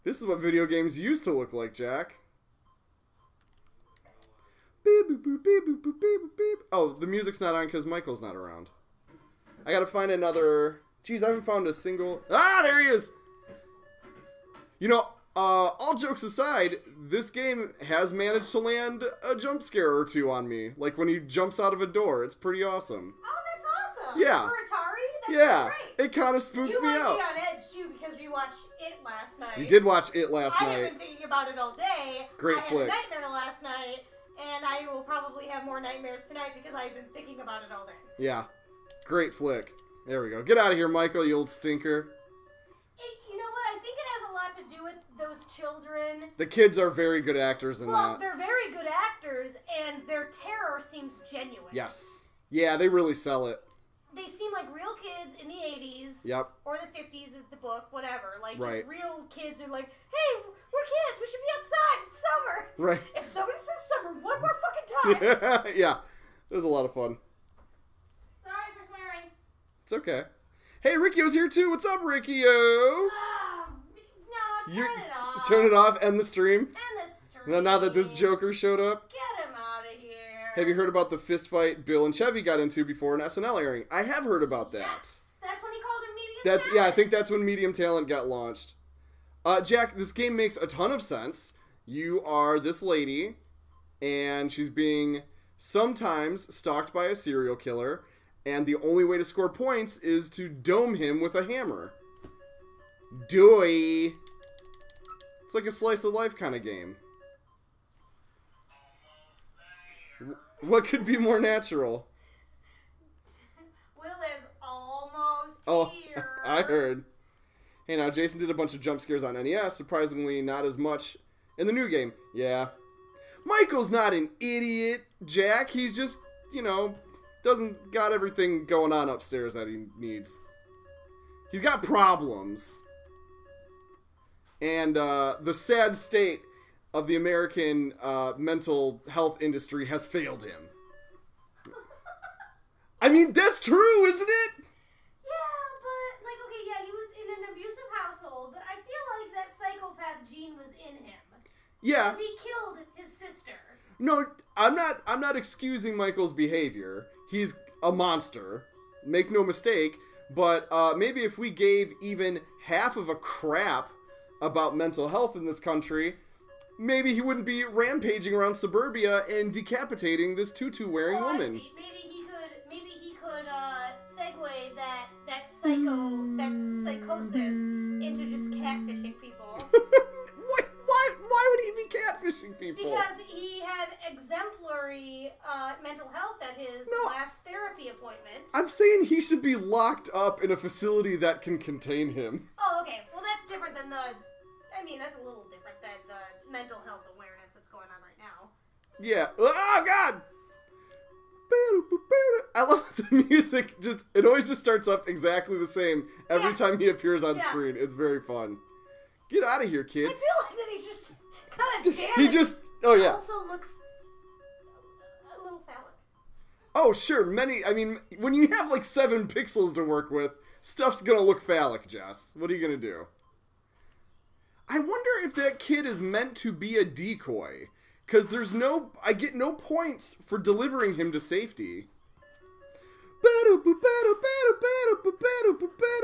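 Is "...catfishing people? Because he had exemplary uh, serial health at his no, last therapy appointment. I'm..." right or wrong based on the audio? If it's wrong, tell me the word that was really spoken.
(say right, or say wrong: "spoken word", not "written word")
wrong: "mental", not "serial".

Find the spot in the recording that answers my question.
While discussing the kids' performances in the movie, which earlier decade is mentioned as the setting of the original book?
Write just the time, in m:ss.
0:56.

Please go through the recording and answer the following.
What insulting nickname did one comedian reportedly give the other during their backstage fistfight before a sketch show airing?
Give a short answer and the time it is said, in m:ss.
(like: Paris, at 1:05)
medium talent, at 1:27.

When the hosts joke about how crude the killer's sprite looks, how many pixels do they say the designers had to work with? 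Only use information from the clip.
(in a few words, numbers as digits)
7.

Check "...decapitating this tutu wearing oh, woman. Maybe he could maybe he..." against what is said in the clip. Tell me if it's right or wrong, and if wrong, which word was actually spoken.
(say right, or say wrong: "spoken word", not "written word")
right.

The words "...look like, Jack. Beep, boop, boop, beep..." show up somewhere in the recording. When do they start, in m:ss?
0:01.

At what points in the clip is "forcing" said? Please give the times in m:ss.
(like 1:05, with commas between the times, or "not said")
not said.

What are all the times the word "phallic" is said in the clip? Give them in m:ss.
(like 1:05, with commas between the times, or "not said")
3:35, 3:41.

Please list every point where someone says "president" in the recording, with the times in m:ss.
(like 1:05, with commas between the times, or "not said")
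not said.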